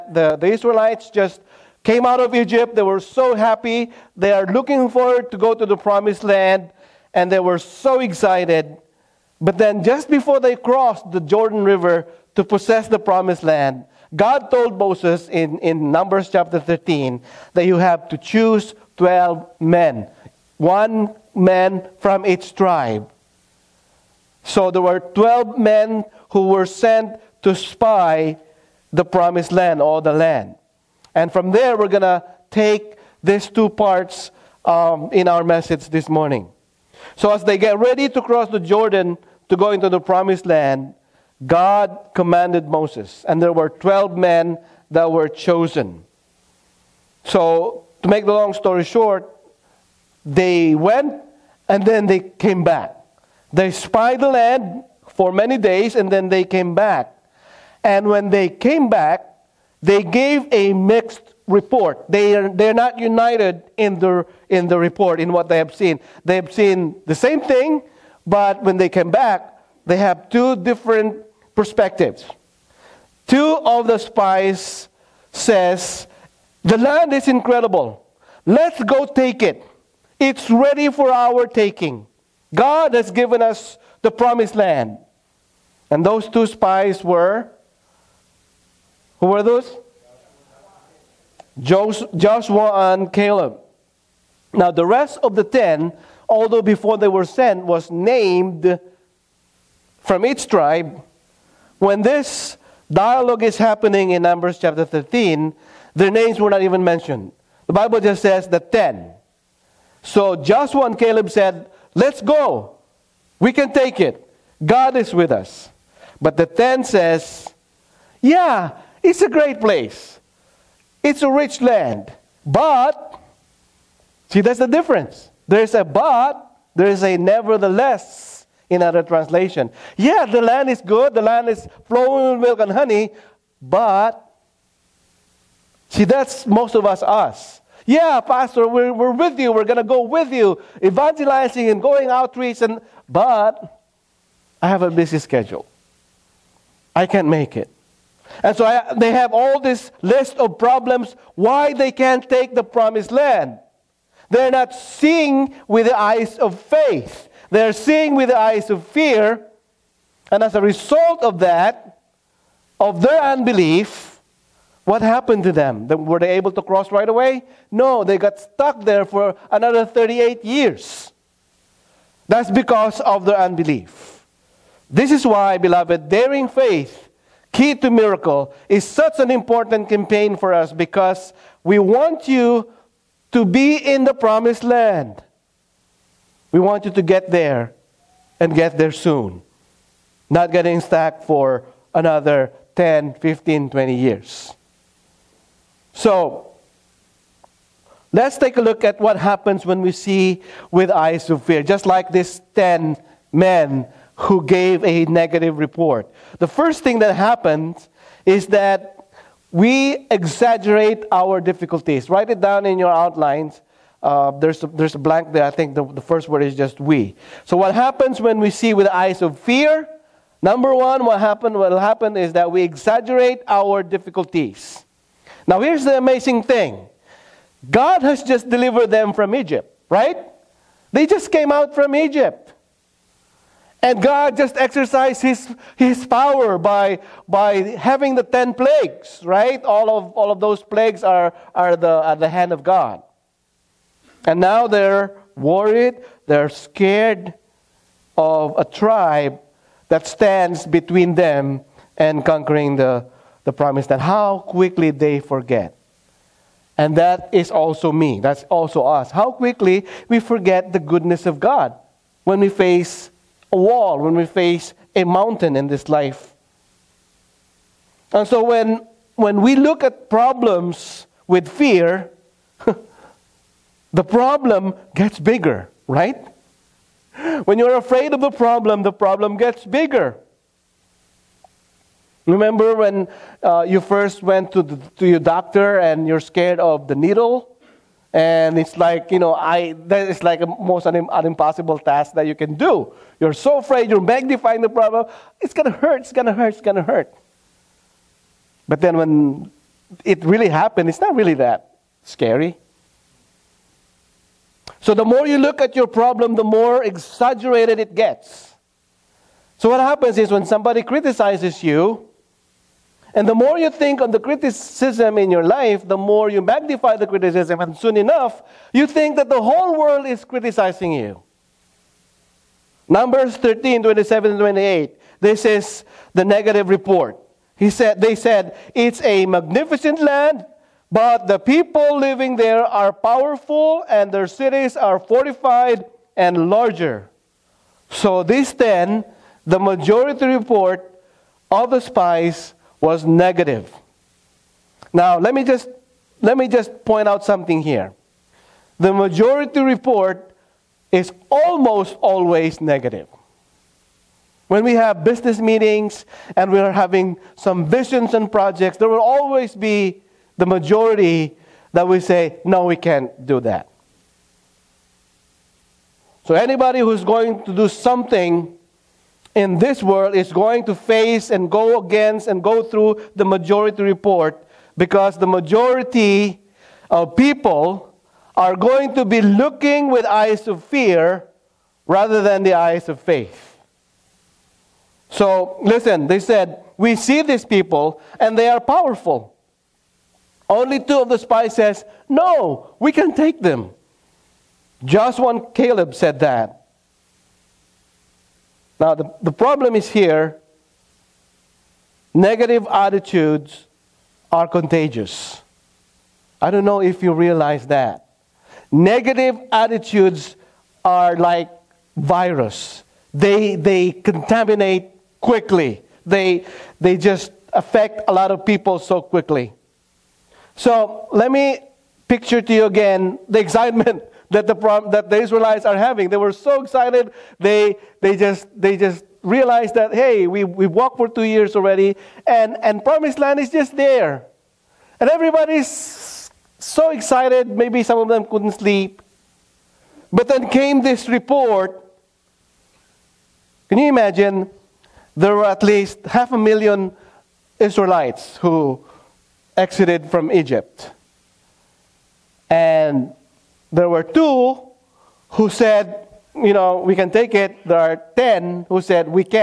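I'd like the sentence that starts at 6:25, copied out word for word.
So, listen, they said, We see these people and they are powerful.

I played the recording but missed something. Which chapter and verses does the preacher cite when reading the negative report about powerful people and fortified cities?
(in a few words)
Numbers 13:27-28.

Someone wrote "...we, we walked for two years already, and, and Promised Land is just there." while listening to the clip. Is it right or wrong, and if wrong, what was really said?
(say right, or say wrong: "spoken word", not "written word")
right.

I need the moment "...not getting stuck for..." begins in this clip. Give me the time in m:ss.
3:10.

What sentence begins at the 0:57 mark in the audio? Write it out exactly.
And when they came back, they gave a mixed report.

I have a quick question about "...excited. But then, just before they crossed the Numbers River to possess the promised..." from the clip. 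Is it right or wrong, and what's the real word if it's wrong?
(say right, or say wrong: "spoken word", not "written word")
wrong: "Jordan", not "Numbers".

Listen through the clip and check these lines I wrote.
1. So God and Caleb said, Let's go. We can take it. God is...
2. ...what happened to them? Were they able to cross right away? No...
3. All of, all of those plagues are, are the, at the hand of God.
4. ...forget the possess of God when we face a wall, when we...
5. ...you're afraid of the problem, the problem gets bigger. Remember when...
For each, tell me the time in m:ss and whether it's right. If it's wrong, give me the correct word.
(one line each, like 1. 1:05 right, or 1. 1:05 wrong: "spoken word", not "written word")
1. 1:50 wrong: "Joshua", not "God"
2. 2:44 right
3. 3:59 right
4. 4:20 wrong: "goodness", not "possess"
5. 4:37 right.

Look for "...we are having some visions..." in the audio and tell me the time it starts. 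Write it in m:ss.
5:56.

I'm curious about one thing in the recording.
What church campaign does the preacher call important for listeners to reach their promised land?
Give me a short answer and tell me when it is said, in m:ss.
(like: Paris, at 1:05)
Daring faith, key to miracle, at 2:56.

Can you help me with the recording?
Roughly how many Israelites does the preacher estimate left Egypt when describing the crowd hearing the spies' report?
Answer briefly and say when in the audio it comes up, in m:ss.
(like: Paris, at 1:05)
Half a million, at 7:26.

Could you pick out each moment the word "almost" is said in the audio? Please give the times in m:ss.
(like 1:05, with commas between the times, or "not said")
5:51.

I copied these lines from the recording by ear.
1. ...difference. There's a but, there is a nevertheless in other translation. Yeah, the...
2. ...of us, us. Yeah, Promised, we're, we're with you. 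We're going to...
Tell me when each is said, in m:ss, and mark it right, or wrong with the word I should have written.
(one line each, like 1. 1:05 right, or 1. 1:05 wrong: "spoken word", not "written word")
1. 2:04 right
2. 2:16 wrong: "Pastor", not "Promised".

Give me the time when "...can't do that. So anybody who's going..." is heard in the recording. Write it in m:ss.
6:02.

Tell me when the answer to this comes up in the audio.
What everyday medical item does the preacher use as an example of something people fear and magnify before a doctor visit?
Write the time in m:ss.
4:46.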